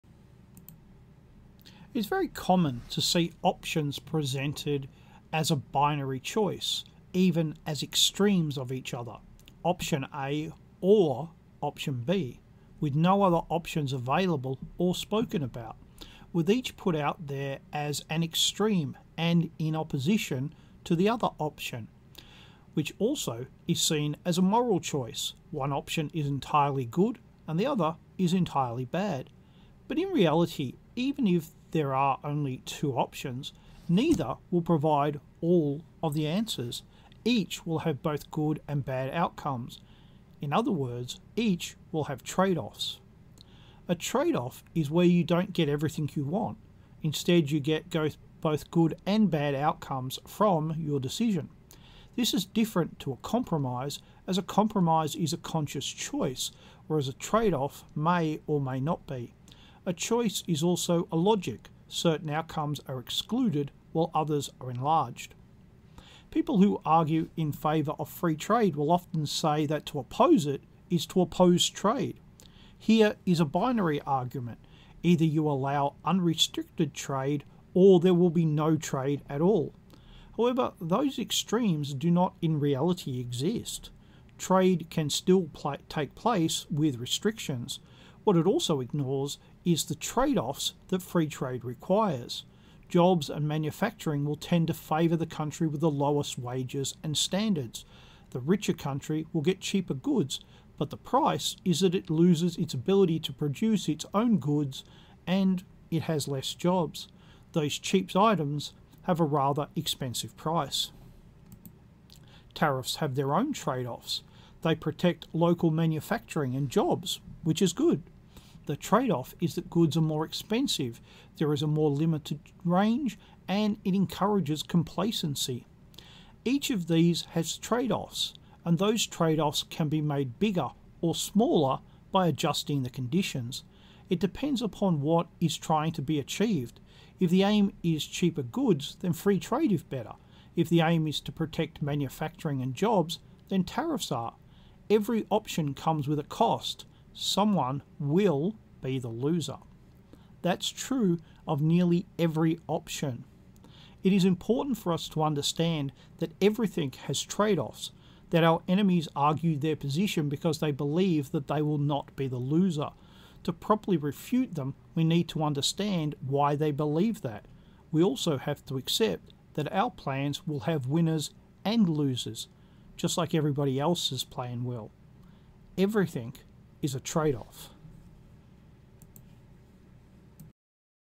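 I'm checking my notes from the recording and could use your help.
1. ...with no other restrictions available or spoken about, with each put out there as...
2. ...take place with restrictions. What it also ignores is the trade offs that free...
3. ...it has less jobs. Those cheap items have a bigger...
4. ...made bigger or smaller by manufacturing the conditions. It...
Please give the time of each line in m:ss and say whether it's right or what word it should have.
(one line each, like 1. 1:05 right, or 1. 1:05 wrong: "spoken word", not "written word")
1. 0:12 wrong: "options", not "restrictions"
2. 1:25 right
3. 1:45 wrong: "rather", not "bigger"
4. 2:09 wrong: "adjusting", not "manufacturing".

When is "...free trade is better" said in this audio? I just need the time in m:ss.
2:19.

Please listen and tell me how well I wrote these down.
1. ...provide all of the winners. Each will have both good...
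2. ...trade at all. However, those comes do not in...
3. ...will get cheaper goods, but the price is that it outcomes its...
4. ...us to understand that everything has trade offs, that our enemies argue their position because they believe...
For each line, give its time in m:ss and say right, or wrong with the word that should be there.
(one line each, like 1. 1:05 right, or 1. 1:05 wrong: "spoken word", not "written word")
1. 0:34 wrong: "answers", not "winners"
2. 1:18 wrong: "extremes", not "comes"
3. 1:39 wrong: "loses", not "outcomes"
4. 2:34 right.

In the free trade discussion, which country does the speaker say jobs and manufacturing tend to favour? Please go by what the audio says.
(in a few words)
The country with the lowest wages.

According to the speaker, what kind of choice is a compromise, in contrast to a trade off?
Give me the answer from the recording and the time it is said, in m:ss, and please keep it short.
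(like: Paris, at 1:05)
A conscious choice, at 0:55.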